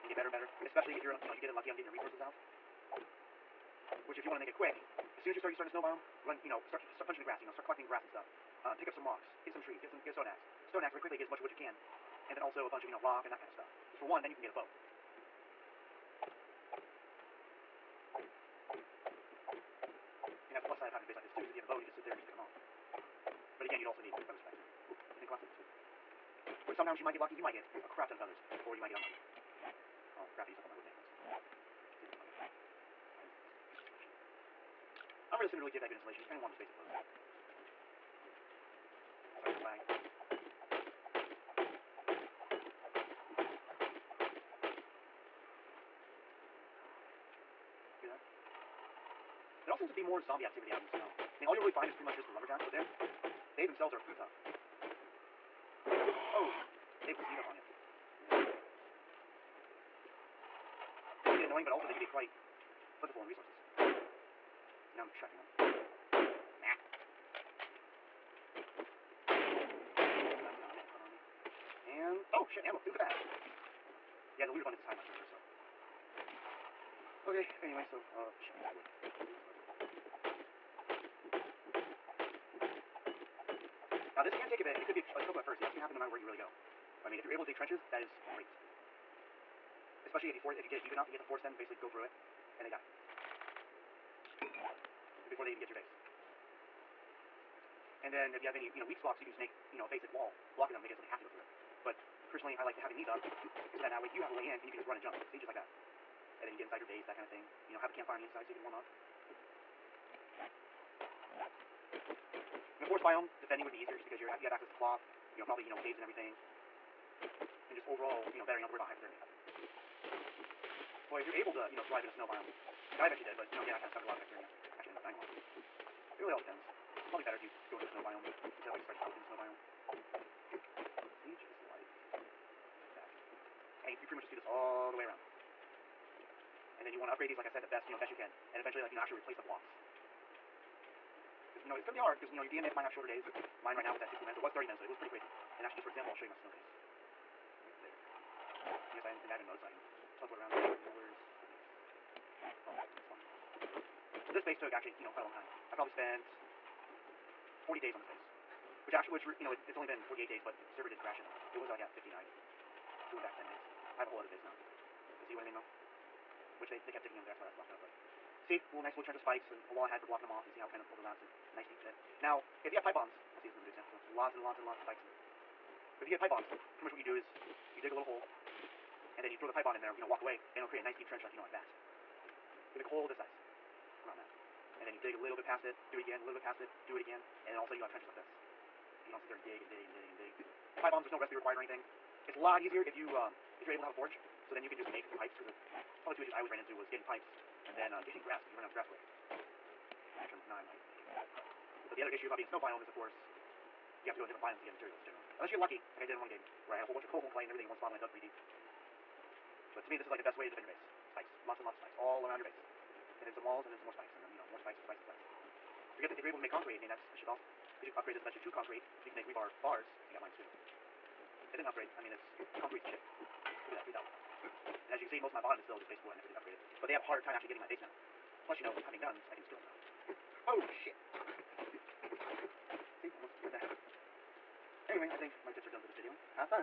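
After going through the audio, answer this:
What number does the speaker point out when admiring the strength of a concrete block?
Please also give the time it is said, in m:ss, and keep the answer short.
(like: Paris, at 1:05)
3,000, at 3:43.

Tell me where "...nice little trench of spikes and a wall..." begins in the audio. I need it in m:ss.
2:48.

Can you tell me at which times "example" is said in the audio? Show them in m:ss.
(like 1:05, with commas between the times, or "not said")
2:25, 2:53.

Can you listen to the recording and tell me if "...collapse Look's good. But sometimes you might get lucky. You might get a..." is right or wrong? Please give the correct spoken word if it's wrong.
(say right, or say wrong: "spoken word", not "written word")
wrong: "That", not "Look".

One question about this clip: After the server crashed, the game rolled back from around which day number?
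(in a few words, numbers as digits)
59.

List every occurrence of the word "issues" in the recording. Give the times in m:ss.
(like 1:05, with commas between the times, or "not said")
3:16, 3:22.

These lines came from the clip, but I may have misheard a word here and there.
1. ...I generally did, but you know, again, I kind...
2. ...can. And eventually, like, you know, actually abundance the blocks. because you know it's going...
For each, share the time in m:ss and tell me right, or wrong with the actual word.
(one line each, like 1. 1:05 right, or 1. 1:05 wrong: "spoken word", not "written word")
1. 2:02 wrong: "eventually", not "generally"
2. 2:18 wrong: "replace", not "abundance".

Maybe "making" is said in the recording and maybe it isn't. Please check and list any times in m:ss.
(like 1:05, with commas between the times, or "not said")
0:30, 1:40, 3:21.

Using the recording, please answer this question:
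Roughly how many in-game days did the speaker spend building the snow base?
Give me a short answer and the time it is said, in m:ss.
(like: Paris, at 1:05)
40 days, at 2:37.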